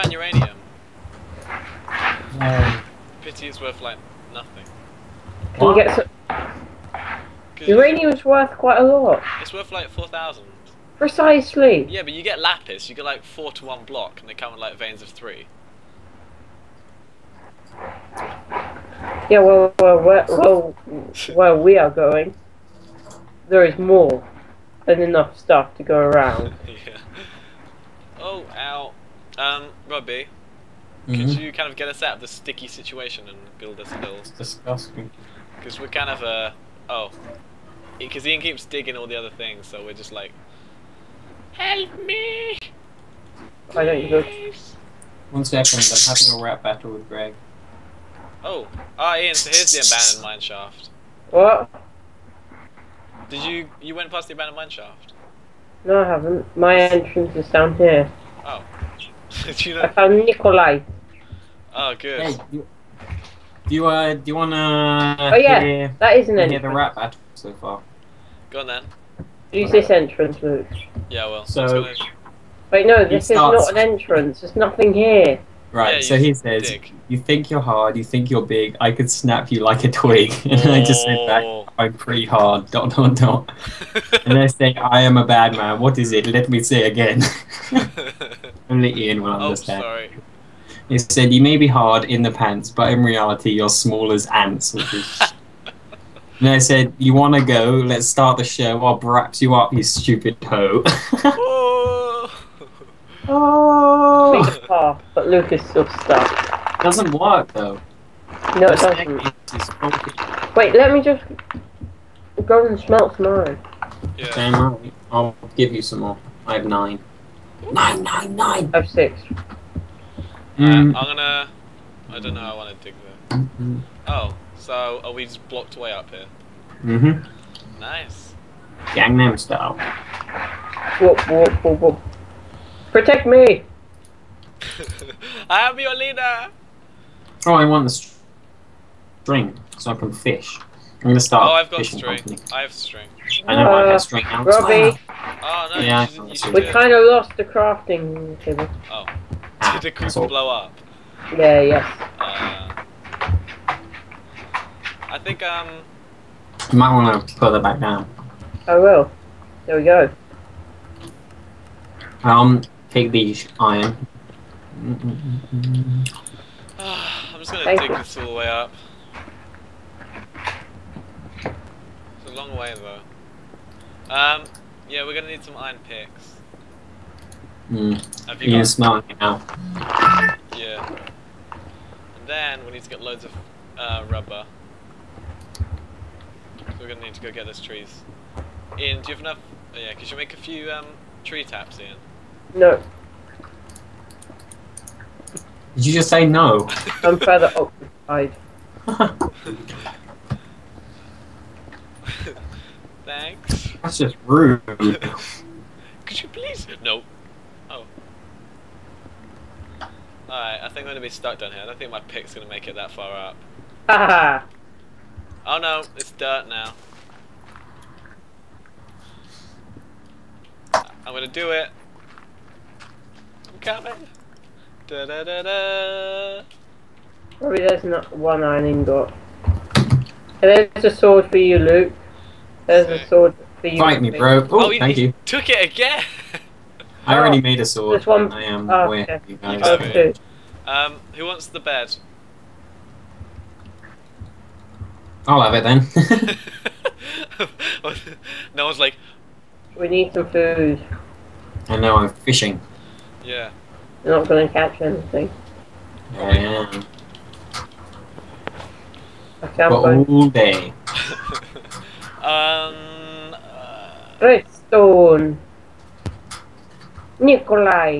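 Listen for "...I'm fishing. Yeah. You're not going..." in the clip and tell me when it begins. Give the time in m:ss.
4:11.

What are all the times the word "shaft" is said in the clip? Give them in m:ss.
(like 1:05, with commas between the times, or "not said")
0:50, 0:54.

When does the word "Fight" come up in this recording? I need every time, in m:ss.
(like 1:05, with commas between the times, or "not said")
3:53.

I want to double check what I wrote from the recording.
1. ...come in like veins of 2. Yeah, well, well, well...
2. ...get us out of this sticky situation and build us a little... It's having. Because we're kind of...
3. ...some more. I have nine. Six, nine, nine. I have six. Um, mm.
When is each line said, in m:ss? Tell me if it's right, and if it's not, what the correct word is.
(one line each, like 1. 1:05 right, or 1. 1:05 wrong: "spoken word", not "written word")
1. 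0:14 wrong: "3", not "2"
2. 0:31 wrong: "disgusting", not "having"
3. 1:55 wrong: "Nine", not "Six".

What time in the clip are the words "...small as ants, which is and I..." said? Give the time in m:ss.
1:33.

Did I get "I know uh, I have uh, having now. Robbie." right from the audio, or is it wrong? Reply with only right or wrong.
wrong.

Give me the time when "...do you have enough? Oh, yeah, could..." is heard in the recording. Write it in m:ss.
3:09.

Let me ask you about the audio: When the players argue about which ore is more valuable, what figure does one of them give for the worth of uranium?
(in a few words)
4,000.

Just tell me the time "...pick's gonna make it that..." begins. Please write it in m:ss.
3:31.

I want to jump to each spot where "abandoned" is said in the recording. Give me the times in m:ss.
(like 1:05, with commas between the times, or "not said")
0:49, 0:54.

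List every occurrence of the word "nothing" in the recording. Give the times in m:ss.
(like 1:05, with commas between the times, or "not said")
0:04, 1:14.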